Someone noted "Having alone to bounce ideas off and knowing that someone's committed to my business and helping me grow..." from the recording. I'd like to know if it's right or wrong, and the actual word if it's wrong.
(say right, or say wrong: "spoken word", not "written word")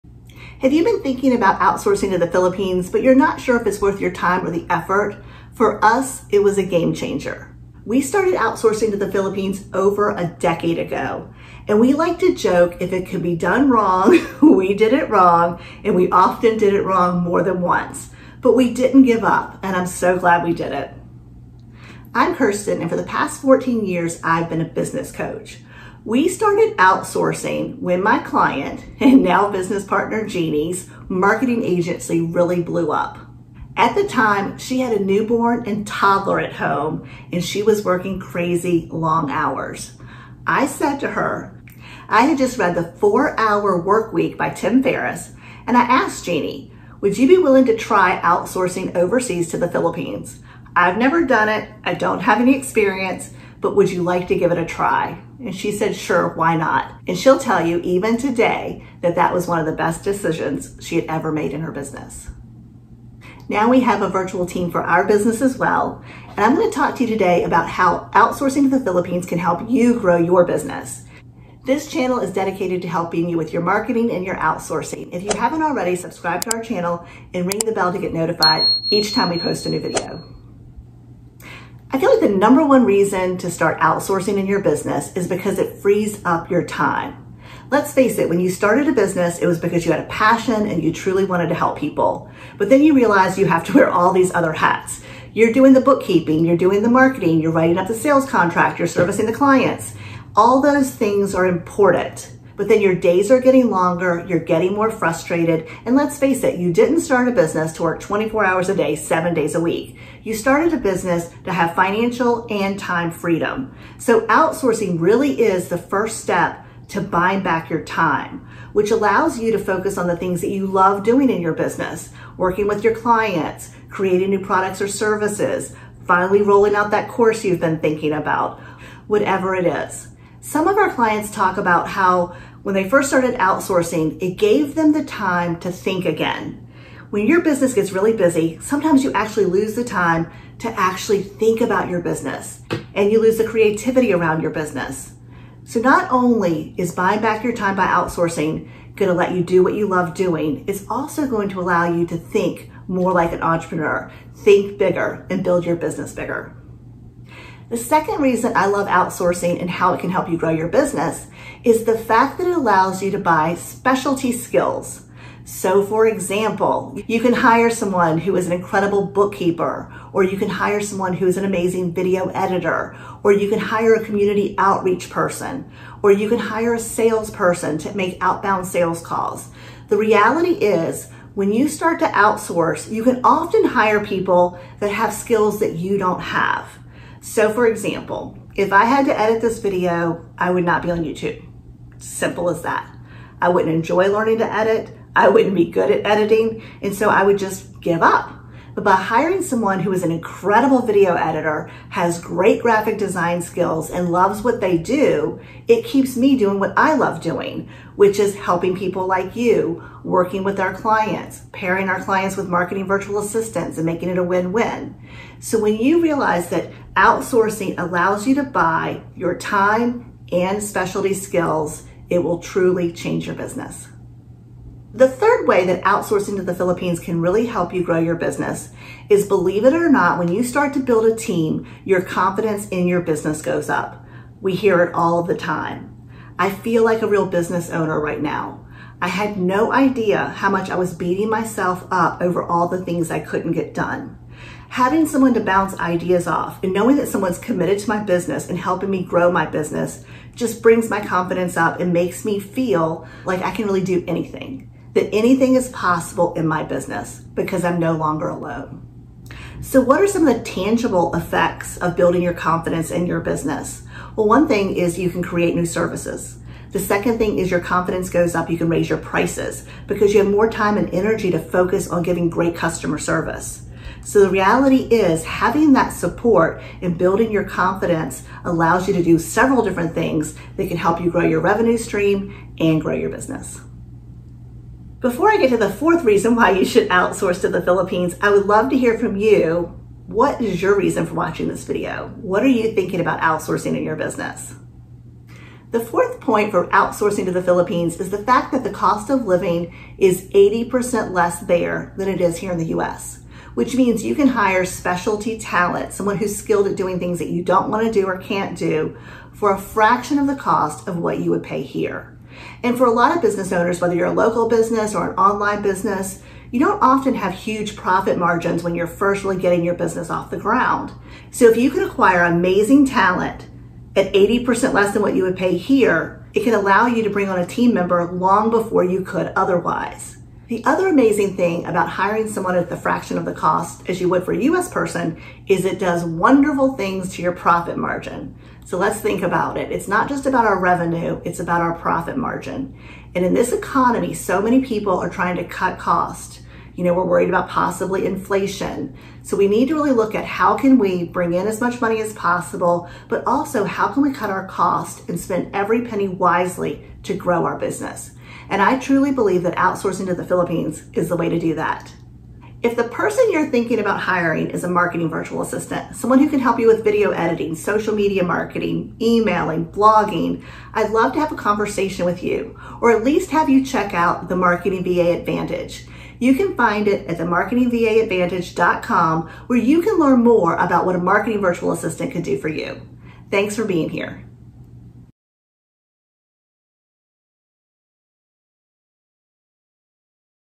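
wrong: "someone", not "alone".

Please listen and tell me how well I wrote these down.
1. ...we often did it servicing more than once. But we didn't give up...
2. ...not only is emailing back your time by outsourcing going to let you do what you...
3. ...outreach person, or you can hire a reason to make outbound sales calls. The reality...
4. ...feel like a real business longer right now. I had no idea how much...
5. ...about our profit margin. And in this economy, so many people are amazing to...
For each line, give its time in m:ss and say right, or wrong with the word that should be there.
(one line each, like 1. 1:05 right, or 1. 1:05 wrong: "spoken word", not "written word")
1. 0:15 wrong: "wrong", not "servicing"
2. 2:25 wrong: "buying", not "emailing"
3. 2:54 wrong: "salesperson", not "reason"
4. 3:56 wrong: "owner", not "longer"
5. 5:41 wrong: "trying", not "amazing".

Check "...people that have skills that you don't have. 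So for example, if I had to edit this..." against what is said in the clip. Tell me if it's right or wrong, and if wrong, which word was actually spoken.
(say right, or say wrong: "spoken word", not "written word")
right.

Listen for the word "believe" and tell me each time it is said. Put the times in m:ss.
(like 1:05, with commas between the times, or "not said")
3:49, 5:59.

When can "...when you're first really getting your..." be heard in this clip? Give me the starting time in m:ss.
5:18.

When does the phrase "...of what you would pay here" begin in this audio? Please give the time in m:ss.
5:10.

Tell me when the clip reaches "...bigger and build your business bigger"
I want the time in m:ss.
2:34.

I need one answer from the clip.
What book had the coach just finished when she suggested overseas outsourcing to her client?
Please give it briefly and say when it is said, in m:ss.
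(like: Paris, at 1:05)
The Four Hour Work Week, at 0:42.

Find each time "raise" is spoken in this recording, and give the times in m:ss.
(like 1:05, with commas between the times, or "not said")
4:28.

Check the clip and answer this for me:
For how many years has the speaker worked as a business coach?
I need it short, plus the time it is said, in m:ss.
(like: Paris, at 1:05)
14, at 0:23.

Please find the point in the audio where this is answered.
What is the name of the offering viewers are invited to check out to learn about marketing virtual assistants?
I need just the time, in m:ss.
6:14.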